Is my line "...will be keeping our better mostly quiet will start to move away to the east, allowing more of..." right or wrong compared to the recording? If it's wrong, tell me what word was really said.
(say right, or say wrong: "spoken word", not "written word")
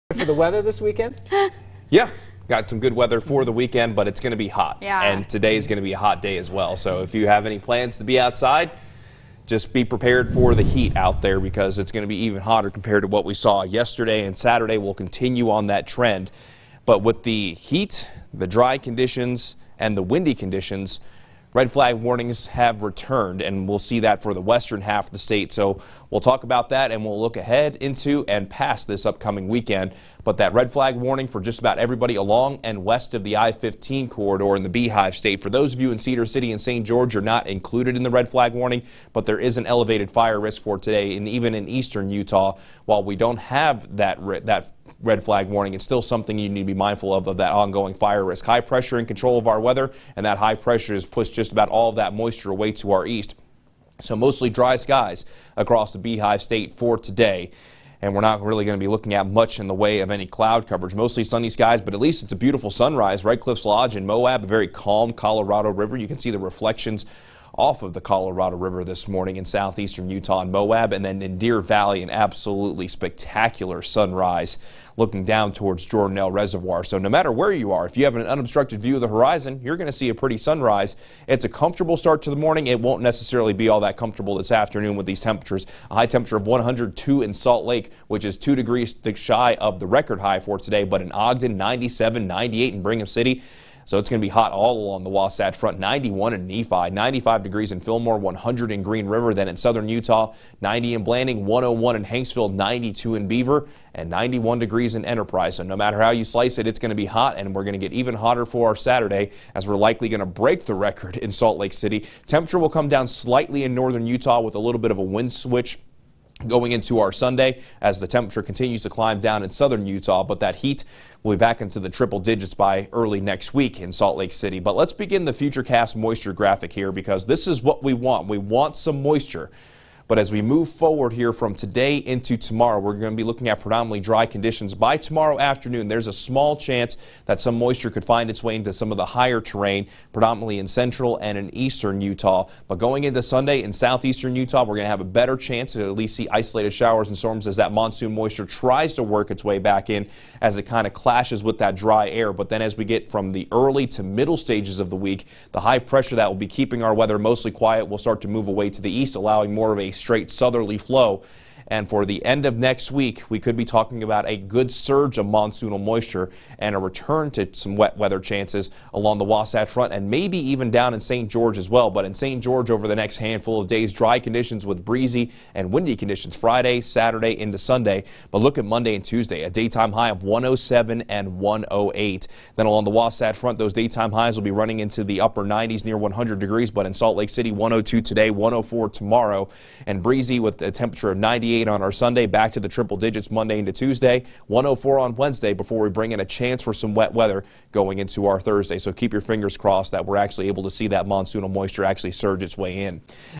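wrong: "weather", not "better".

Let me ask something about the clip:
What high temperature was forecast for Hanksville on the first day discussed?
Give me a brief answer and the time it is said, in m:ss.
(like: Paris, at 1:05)
101, at 1:41.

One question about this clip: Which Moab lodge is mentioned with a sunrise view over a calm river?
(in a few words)
Red Cliffs Lodge.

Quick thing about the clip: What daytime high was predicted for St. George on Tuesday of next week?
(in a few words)
108.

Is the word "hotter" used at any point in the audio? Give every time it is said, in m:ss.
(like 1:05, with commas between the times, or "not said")
0:12, 1:48.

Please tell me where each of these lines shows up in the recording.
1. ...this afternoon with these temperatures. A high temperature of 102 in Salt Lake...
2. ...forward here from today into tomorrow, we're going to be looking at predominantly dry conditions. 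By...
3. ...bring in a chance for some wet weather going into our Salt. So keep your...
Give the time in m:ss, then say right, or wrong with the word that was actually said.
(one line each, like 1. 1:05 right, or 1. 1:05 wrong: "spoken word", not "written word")
1. 1:24 right
2. 2:10 right
3. 3:15 wrong: "Thursday", not "Salt".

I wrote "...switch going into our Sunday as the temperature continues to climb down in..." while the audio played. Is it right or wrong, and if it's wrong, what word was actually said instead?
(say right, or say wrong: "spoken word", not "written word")
right.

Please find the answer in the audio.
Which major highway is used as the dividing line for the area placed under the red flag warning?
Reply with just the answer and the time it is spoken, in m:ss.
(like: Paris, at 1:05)
I-15, at 0:33.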